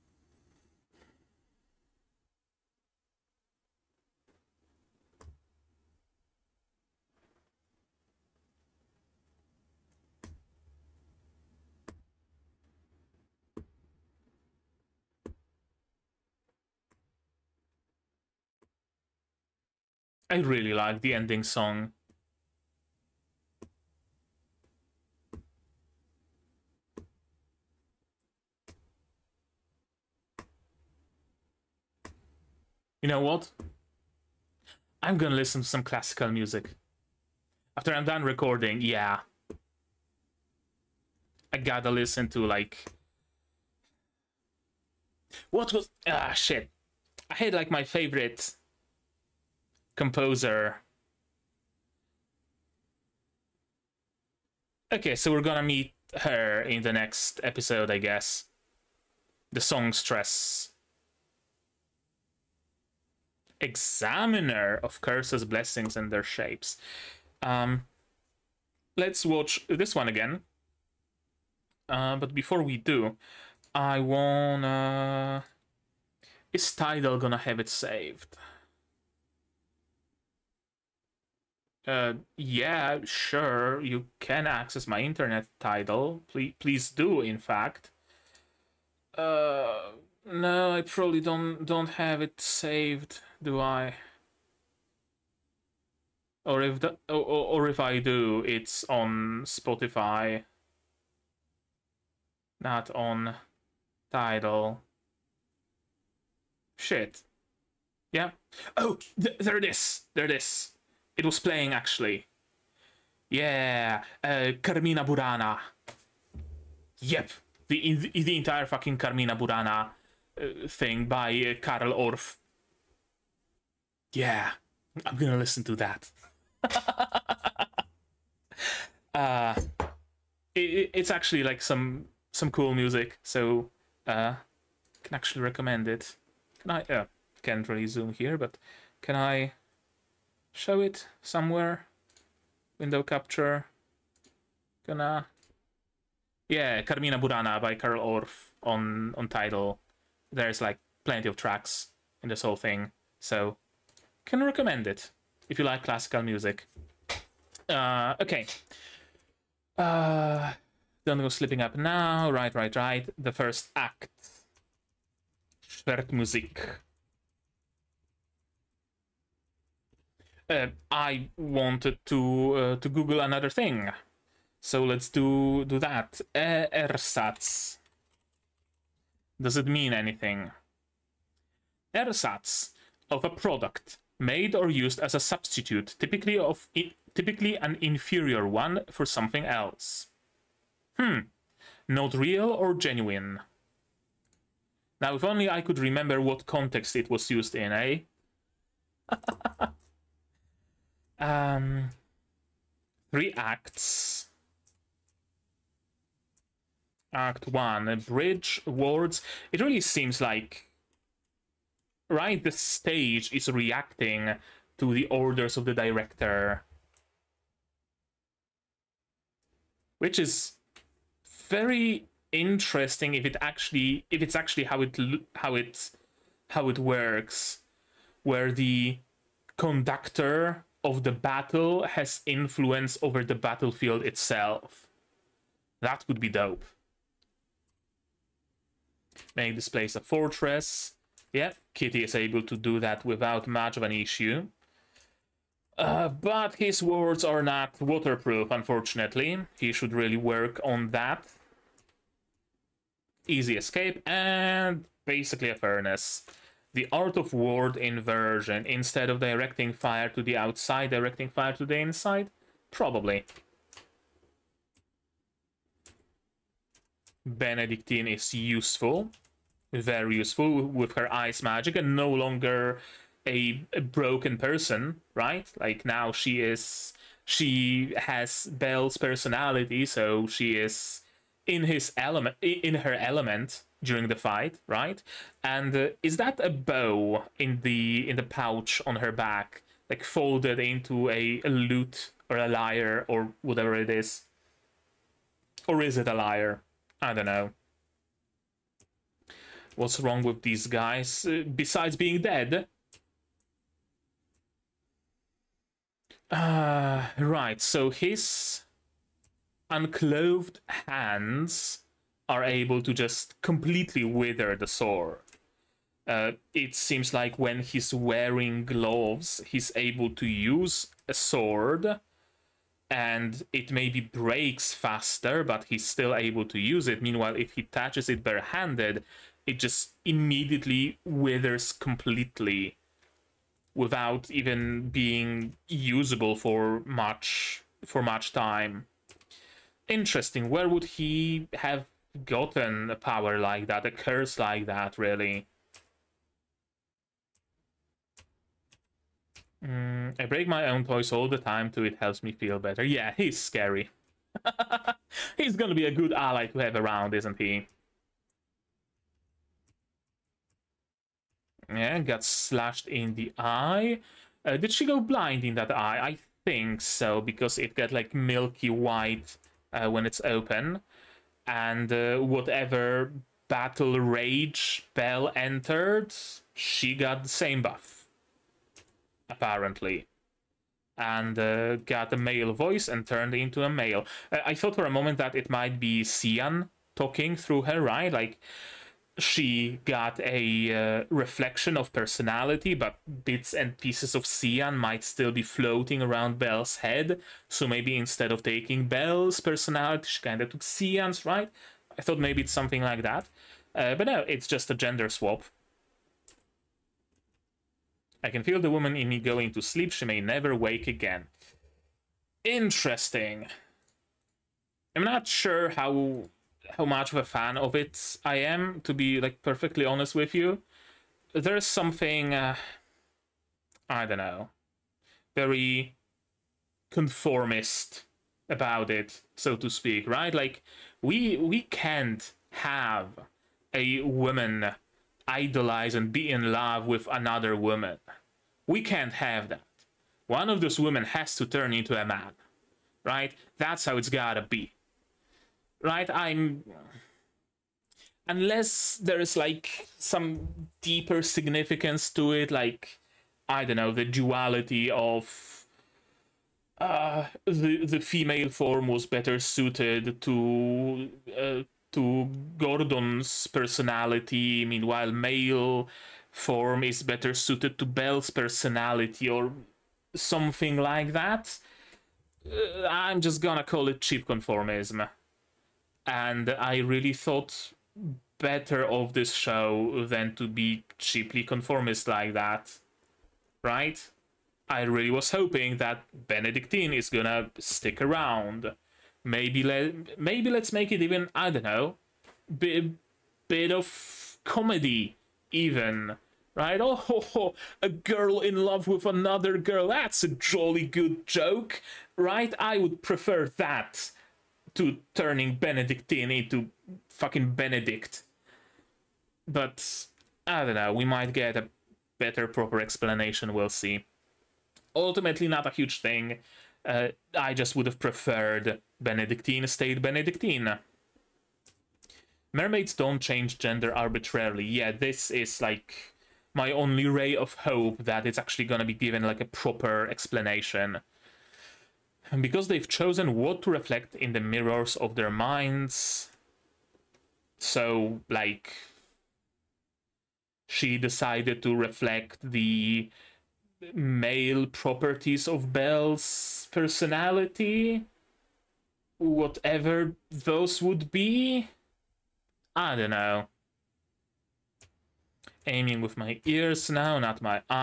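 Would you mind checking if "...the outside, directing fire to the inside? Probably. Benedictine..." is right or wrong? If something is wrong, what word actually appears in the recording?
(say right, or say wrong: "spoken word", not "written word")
right.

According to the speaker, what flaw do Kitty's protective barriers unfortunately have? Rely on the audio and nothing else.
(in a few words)
not waterproof.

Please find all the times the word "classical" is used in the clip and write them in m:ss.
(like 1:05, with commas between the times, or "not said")
0:35, 2:35.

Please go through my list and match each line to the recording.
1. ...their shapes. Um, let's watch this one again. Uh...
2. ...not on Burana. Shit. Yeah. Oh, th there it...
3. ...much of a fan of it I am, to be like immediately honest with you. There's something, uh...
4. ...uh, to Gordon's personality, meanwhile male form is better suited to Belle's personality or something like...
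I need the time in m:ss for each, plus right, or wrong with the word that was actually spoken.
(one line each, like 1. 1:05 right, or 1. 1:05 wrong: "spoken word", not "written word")
1. 1:06 right
2. 1:42 wrong: "Tidal", not "Burana"
3. 6:56 wrong: "perfectly", not "immediately"
4. 7:41 right.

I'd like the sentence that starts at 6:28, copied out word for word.
Like, she got a uh, reflection of personality, but bits and pieces of Sian might still be floating around Belle's head.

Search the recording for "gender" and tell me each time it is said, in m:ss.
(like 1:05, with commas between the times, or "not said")
6:44, 8:43.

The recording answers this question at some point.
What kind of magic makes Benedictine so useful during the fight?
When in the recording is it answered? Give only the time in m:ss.
4:31.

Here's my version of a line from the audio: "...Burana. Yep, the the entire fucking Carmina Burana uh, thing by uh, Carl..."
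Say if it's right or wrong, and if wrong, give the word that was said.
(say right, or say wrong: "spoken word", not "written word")
right.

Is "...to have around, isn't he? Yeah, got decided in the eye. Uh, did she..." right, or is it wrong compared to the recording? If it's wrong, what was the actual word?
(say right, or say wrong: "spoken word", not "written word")
wrong: "slashed", not "decided".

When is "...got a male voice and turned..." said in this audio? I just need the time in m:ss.
6:21.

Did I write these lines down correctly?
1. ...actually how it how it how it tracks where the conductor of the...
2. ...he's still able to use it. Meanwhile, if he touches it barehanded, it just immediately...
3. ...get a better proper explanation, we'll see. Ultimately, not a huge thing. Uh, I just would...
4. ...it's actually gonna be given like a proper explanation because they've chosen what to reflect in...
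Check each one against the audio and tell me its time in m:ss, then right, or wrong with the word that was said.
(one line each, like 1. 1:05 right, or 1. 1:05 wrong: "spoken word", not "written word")
1. 3:44 wrong: "works", not "tracks"
2. 5:25 right
3. 8:31 right
4. 8:48 right.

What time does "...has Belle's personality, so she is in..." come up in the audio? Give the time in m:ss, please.
4:37.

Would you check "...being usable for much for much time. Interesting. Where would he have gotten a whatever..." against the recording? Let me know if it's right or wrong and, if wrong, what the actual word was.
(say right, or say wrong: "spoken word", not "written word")
wrong: "power", not "whatever".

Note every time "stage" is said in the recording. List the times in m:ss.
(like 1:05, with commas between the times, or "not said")
3:32.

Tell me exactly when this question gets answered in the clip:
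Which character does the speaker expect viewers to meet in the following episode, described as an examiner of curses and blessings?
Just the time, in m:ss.
0:59.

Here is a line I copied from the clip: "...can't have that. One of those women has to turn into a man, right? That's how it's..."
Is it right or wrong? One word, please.
right.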